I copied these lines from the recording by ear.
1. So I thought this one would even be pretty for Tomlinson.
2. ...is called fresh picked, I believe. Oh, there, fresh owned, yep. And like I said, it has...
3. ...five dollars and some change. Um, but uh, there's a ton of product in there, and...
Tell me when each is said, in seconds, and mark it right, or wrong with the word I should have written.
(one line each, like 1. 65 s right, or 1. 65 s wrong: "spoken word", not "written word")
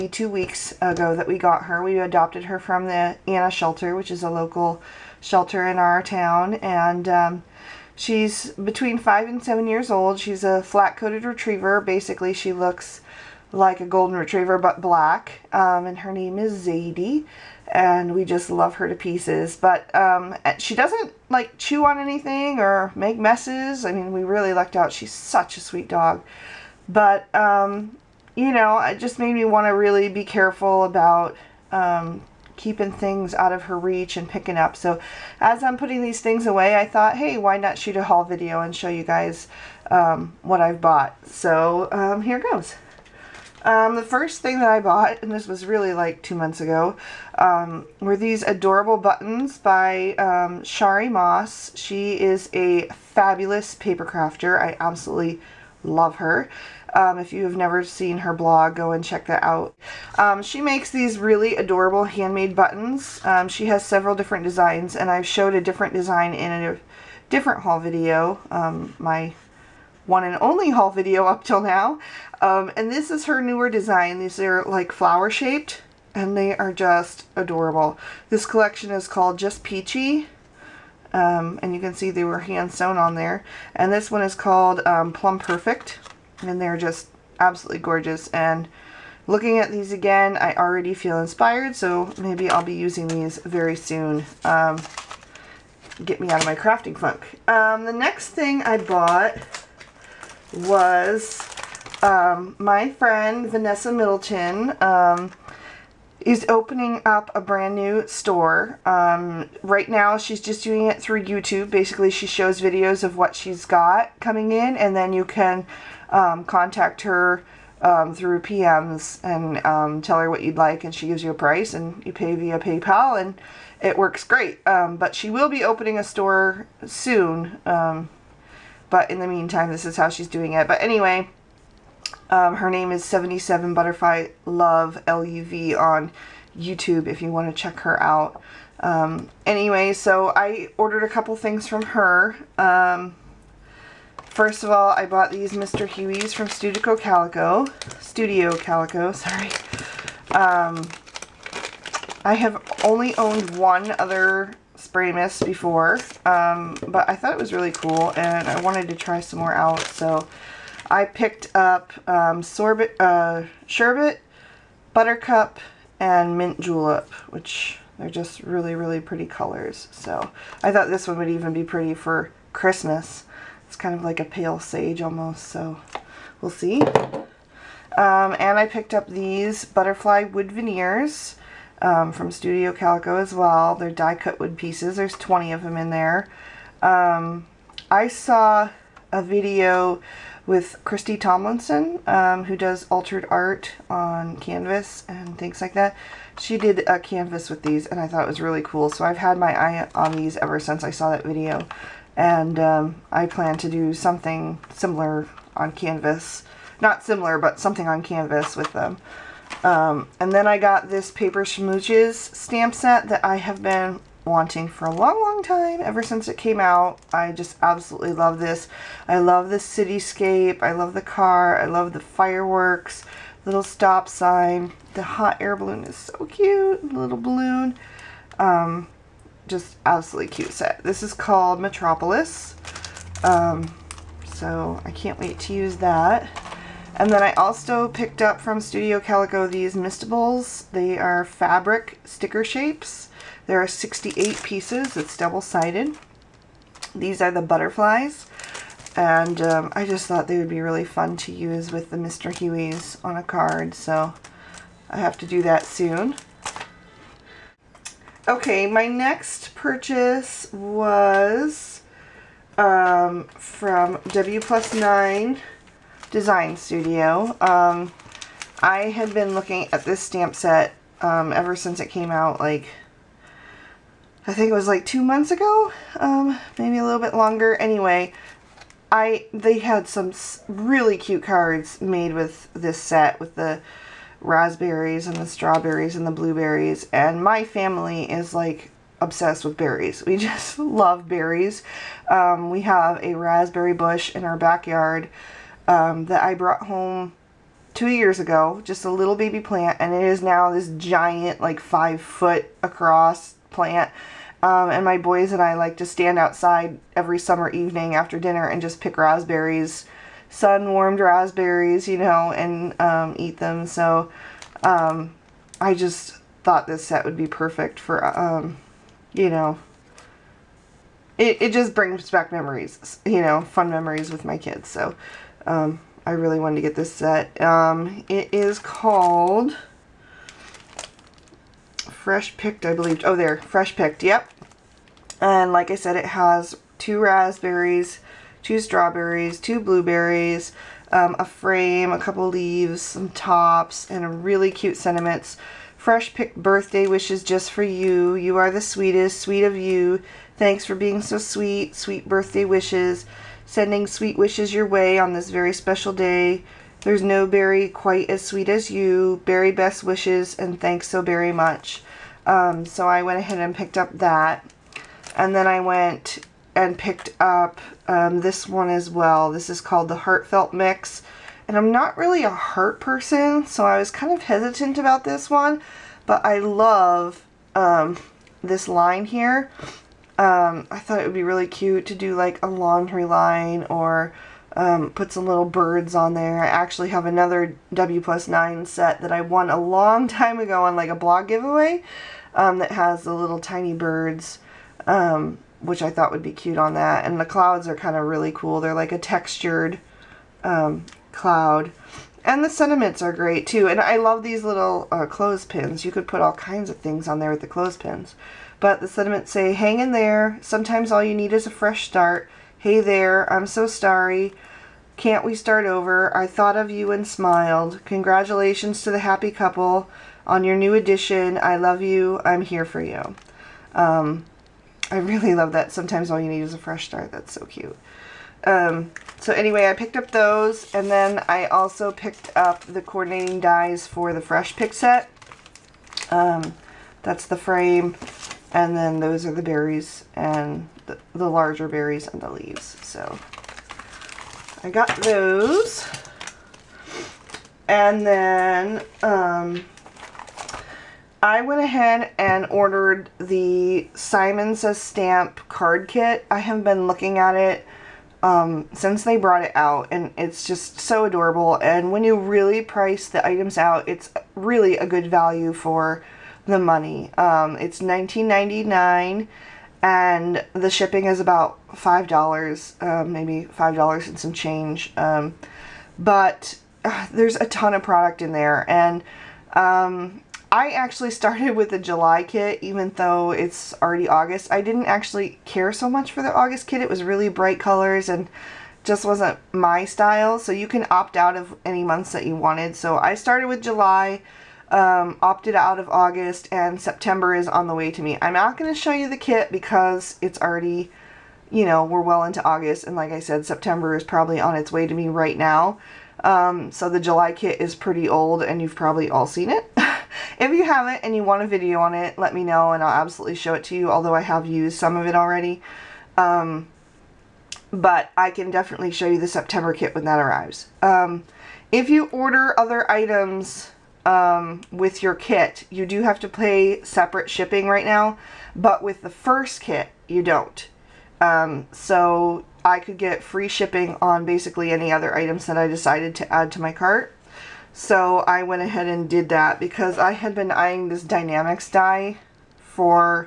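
1. 169 s wrong: "Christmas", not "Tomlinson"
2. 328 s wrong: "picked", not "owned"
3. 473 s right.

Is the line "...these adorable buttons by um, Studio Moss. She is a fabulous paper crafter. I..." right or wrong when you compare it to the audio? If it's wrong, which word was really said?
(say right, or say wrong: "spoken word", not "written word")
wrong: "Shari", not "Studio".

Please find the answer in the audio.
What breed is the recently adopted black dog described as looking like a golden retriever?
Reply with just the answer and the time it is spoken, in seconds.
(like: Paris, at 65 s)
Flat-coated retriever, at 10 s.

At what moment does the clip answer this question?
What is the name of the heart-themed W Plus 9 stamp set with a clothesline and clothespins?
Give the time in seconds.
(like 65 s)
369 s.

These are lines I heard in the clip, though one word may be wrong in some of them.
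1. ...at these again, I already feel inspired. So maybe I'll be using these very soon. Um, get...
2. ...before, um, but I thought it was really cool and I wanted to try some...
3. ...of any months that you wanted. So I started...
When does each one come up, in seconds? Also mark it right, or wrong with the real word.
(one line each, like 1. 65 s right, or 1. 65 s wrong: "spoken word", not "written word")
1. 89 s right
2. 155 s right
3. 491 s right.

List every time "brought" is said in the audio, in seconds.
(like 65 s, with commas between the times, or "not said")
296 s, 459 s.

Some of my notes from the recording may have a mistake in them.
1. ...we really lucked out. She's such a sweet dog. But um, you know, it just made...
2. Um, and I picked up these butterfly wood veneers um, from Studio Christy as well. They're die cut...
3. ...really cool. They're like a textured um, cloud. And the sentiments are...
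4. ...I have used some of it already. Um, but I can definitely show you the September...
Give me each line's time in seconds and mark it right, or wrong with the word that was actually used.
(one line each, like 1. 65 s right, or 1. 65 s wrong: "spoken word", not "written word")
1. 24 s right
2. 176 s wrong: "Calico", not "Christy"
3. 398 s right
4. 514 s right.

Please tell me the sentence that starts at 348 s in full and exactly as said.
You are the sweetest, sweet of you.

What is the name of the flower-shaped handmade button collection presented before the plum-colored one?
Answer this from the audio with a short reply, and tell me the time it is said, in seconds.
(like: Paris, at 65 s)
Just Peachy, at 79 s.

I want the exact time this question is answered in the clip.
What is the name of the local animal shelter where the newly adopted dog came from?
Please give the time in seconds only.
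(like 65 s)
3 s.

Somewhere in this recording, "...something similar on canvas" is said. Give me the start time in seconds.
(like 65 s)
203 s.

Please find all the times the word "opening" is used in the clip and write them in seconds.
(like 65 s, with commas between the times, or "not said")
106 s, 125 s.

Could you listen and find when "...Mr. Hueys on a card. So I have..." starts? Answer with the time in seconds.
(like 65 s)
251 s.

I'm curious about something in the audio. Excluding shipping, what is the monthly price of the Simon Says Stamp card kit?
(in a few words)
$19.99.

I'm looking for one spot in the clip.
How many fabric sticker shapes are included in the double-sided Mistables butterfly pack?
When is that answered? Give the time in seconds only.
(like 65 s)
243 s.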